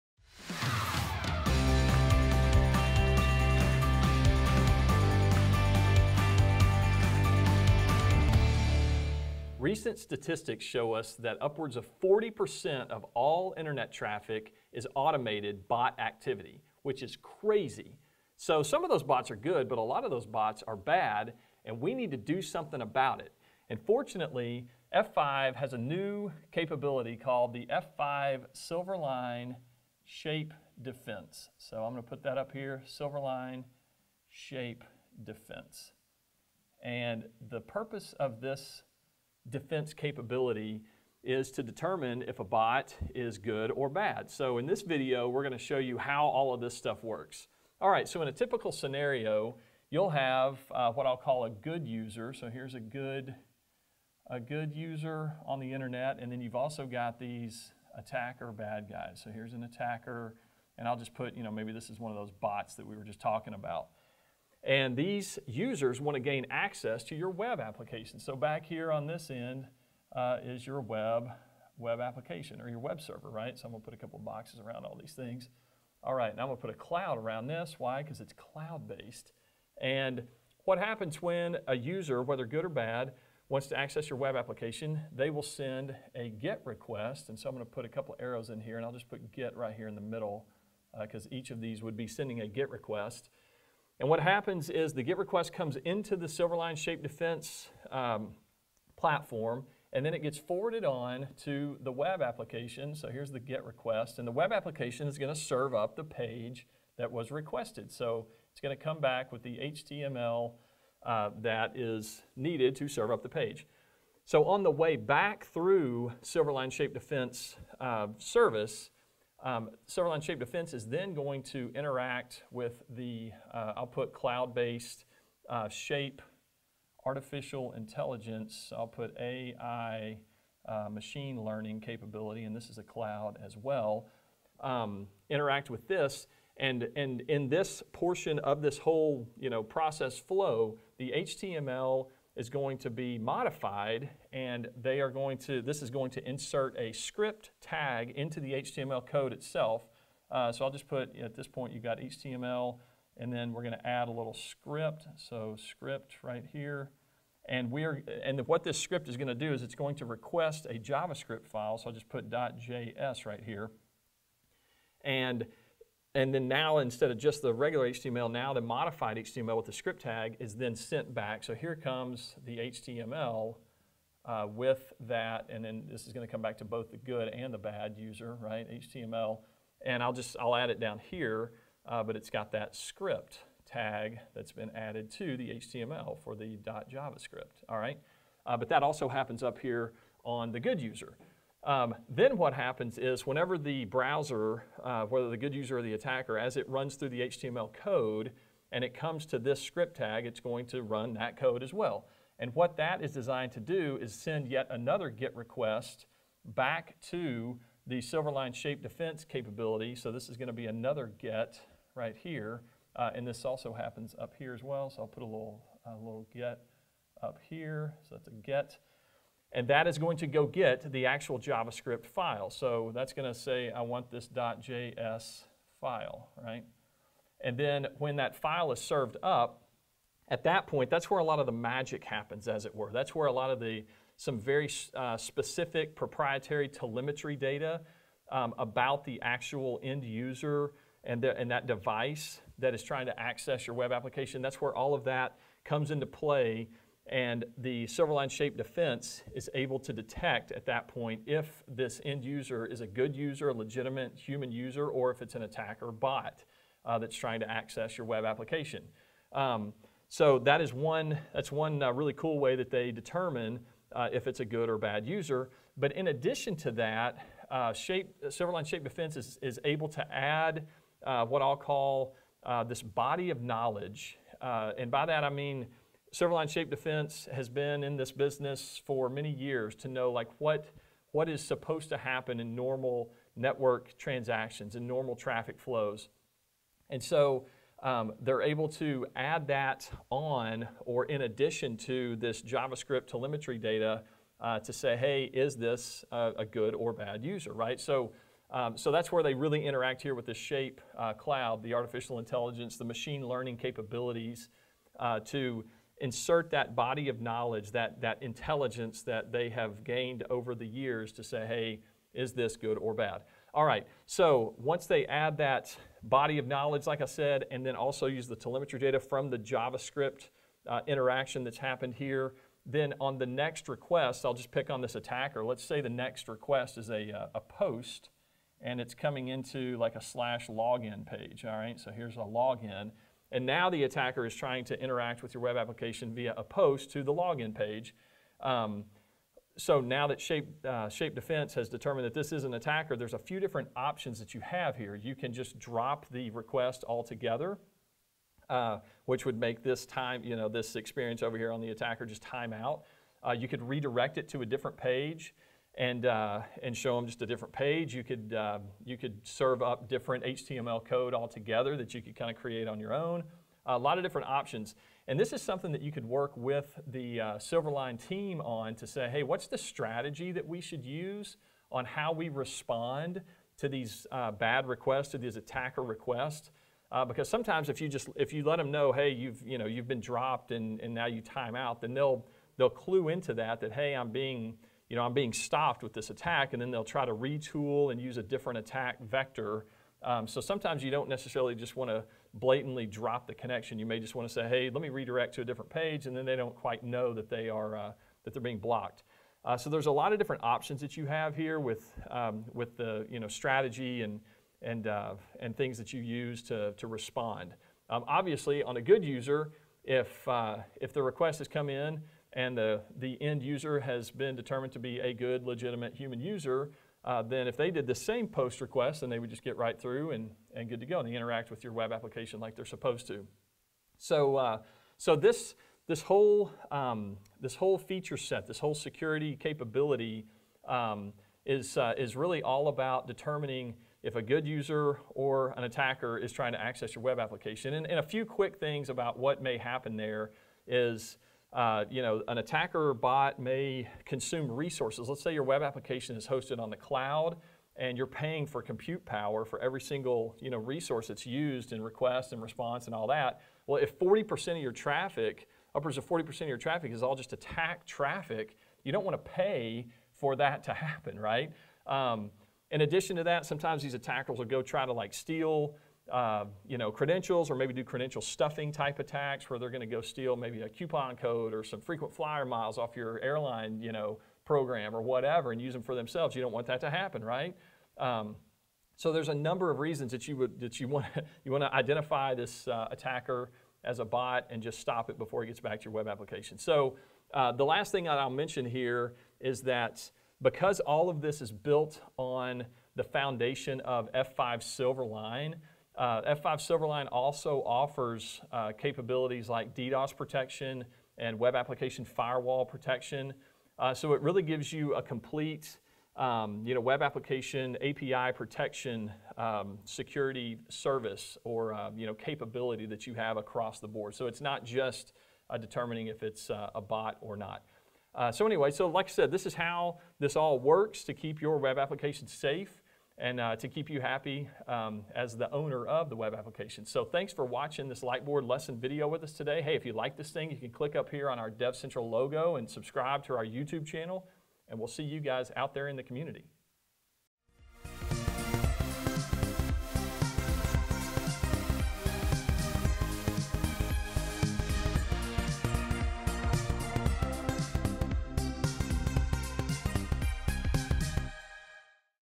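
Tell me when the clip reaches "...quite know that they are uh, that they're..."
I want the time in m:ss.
6:36.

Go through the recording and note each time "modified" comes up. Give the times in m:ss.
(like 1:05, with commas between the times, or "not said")
2:23, 2:48.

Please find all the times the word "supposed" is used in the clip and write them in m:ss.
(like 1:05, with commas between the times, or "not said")
4:41, 7:02.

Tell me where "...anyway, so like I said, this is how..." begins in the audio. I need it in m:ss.
8:38.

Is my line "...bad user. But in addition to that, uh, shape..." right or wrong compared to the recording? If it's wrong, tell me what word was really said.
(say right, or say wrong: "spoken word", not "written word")
right.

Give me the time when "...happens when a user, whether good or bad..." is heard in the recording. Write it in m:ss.
1:20.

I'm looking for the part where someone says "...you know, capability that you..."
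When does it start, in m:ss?
8:31.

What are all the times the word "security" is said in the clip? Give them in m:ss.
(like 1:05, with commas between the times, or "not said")
7:08, 8:29.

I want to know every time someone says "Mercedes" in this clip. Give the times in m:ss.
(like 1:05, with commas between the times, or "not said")
not said.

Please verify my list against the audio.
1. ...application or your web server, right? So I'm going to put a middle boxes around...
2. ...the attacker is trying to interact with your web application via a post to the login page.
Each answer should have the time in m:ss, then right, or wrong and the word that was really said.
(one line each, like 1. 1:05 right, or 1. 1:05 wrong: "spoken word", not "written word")
1. 1:11 wrong: "couple", not "middle"
2. 5:33 right.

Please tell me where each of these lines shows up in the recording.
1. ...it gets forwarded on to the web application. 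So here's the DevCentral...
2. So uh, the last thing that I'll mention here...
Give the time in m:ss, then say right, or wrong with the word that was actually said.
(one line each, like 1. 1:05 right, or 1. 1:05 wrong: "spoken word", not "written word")
1. 1:40 wrong: "GET", not "DevCentral"
2. 8:06 right.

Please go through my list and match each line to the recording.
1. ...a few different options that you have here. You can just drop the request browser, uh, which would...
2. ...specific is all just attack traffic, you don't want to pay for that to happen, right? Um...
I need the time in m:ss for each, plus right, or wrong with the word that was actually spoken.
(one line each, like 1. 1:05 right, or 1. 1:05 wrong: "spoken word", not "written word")
1. 5:43 wrong: "altogether", not "browser"
2. 7:36 wrong: "traffic", not "specific".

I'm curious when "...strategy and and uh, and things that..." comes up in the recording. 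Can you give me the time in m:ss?
6:43.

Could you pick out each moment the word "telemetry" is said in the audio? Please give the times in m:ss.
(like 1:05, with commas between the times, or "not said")
3:56, 4:53, 5:18.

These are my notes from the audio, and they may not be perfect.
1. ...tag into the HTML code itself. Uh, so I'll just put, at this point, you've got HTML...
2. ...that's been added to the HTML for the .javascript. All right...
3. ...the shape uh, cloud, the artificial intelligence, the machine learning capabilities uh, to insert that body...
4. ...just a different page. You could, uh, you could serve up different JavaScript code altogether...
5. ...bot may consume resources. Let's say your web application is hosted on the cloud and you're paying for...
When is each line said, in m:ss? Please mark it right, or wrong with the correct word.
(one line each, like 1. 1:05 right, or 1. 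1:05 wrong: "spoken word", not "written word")
1. 2:27 right
2. 3:04 right
3. 5:00 right
4. 5:57 wrong: "HTML", not "JavaScript"
5. 7:22 right.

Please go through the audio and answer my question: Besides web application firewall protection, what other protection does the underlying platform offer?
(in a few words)
DDoS protection.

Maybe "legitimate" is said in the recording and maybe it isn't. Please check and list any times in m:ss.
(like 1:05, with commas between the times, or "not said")
4:13, 6:55.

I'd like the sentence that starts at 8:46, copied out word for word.
So thanks for watching this Lightboard lesson video with us today.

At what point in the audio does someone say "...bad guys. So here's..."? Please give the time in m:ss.
0:58.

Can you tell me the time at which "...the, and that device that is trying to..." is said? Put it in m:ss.
4:01.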